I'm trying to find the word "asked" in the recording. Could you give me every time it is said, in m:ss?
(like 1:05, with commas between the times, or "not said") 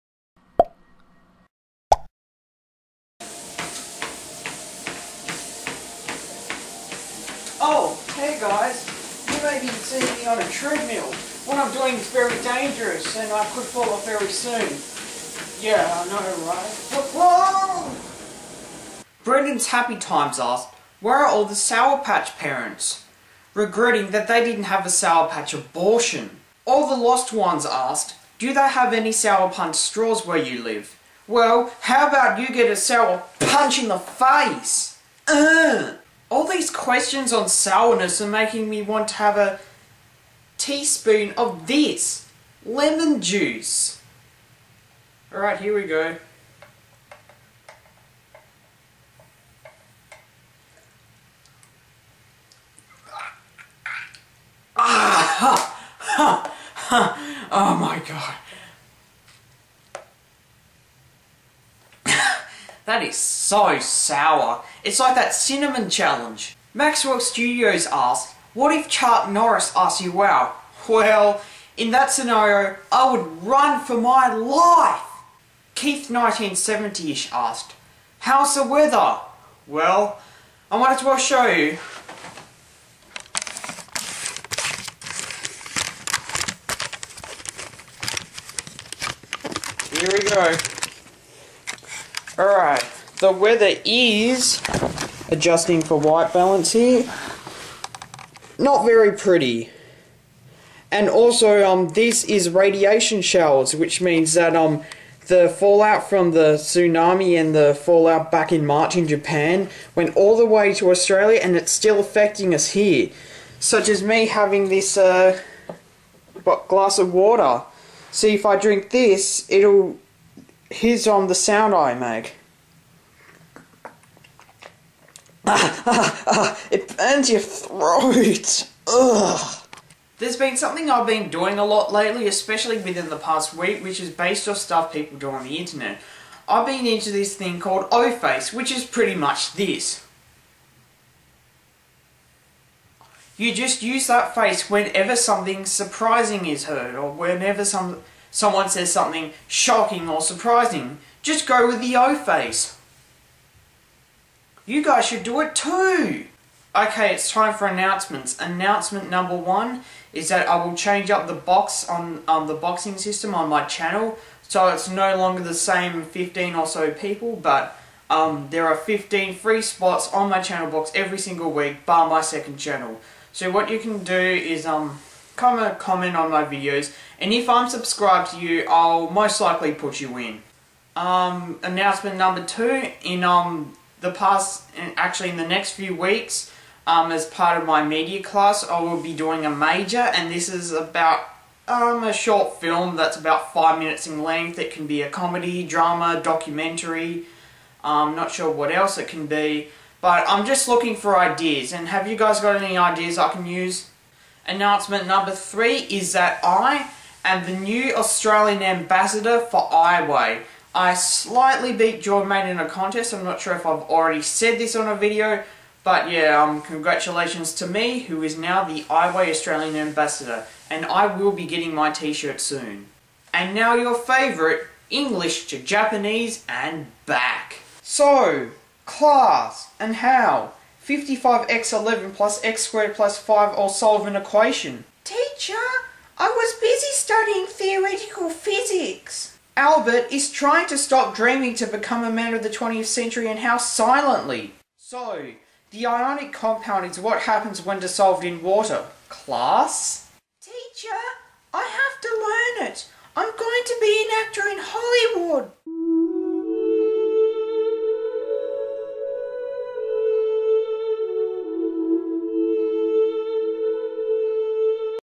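0:20, 0:27, 1:07, 1:17.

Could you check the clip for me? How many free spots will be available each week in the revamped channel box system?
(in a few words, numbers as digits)
15.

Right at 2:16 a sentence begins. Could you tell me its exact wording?
I've been into this thing called O-Face, which is pretty much this.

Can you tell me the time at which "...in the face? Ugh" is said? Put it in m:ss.
0:33.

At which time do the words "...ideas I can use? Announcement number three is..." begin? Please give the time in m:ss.
3:22.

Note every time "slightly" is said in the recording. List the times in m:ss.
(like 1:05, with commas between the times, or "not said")
3:30.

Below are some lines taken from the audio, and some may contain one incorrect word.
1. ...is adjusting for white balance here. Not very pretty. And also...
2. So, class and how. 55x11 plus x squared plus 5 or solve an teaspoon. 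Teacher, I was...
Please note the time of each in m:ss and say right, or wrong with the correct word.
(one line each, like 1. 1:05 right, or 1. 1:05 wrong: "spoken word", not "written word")
1. 1:33 right
2. 3:47 wrong: "equation", not "teaspoon".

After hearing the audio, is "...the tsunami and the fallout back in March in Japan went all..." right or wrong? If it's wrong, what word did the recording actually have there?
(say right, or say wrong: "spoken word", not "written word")
right.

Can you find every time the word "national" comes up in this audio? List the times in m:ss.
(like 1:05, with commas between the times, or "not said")
not said.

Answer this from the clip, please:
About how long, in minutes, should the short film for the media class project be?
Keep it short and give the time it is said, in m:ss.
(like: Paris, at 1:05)
5 minutes, at 3:13.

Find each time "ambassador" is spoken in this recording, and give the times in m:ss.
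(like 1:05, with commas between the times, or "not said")
3:28, 3:39.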